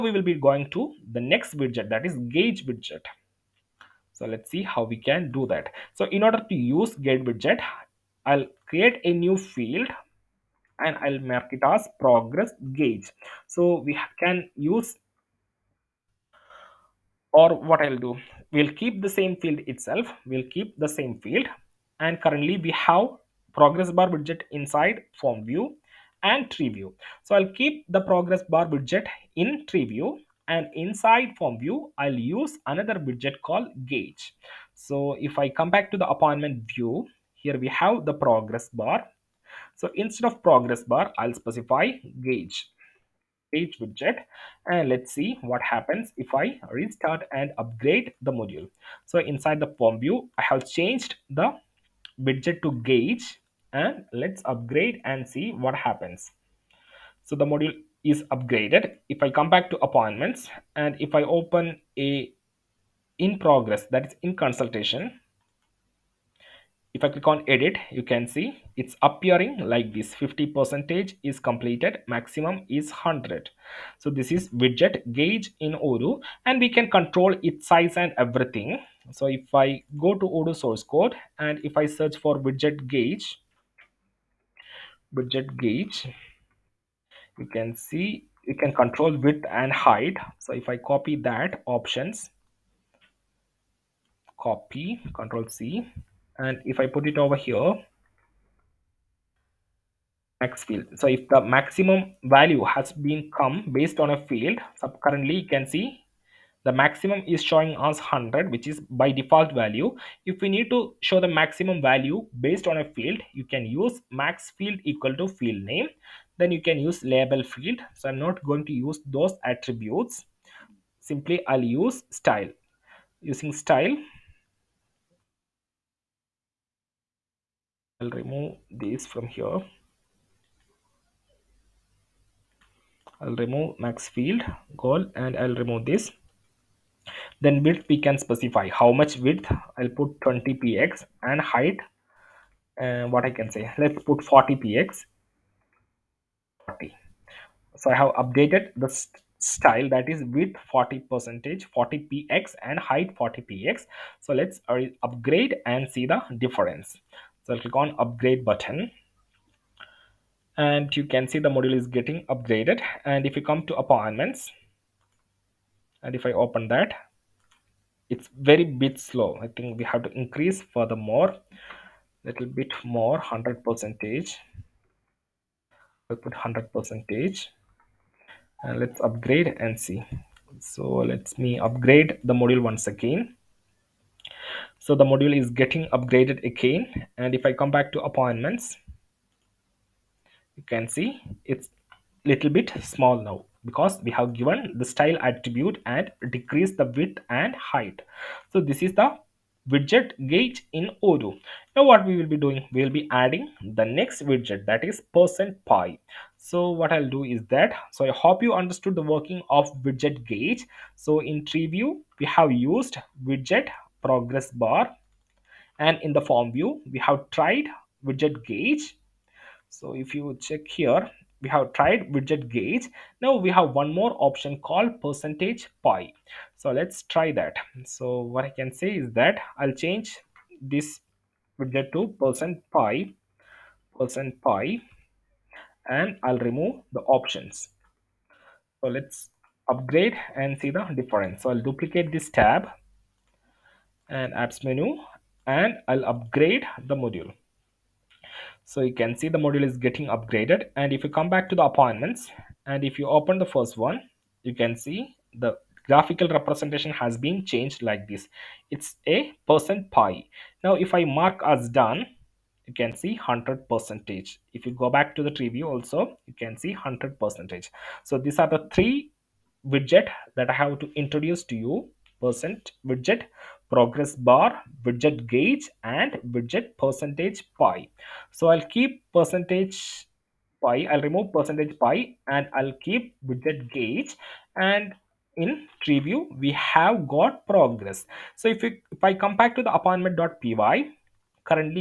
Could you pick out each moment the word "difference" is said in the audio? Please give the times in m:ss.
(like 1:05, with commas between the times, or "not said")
2:36, 4:01.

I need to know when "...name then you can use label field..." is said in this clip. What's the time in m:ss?
1:55.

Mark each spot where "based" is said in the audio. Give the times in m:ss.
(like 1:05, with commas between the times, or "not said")
1:43, 1:52.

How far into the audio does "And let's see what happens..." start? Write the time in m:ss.
0:44.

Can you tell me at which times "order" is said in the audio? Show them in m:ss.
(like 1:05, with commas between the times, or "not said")
0:06.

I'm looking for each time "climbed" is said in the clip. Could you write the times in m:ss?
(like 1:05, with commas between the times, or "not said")
not said.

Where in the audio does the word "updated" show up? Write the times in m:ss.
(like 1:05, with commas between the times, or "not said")
2:28.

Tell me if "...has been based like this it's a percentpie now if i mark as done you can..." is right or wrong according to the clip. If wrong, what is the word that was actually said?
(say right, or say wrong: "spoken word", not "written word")
wrong: "changed", not "based".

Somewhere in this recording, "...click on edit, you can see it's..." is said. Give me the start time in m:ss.
1:07.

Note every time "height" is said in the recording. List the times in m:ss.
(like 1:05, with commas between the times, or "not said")
1:29, 2:21, 2:32, 3:17.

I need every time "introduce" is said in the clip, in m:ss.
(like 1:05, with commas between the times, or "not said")
4:30.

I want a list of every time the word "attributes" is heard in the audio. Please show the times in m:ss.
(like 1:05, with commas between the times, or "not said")
1:59, 3:15.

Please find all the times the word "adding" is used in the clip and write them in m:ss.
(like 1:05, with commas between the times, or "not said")
3:23.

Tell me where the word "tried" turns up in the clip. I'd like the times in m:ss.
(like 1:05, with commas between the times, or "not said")
3:37, 3:41.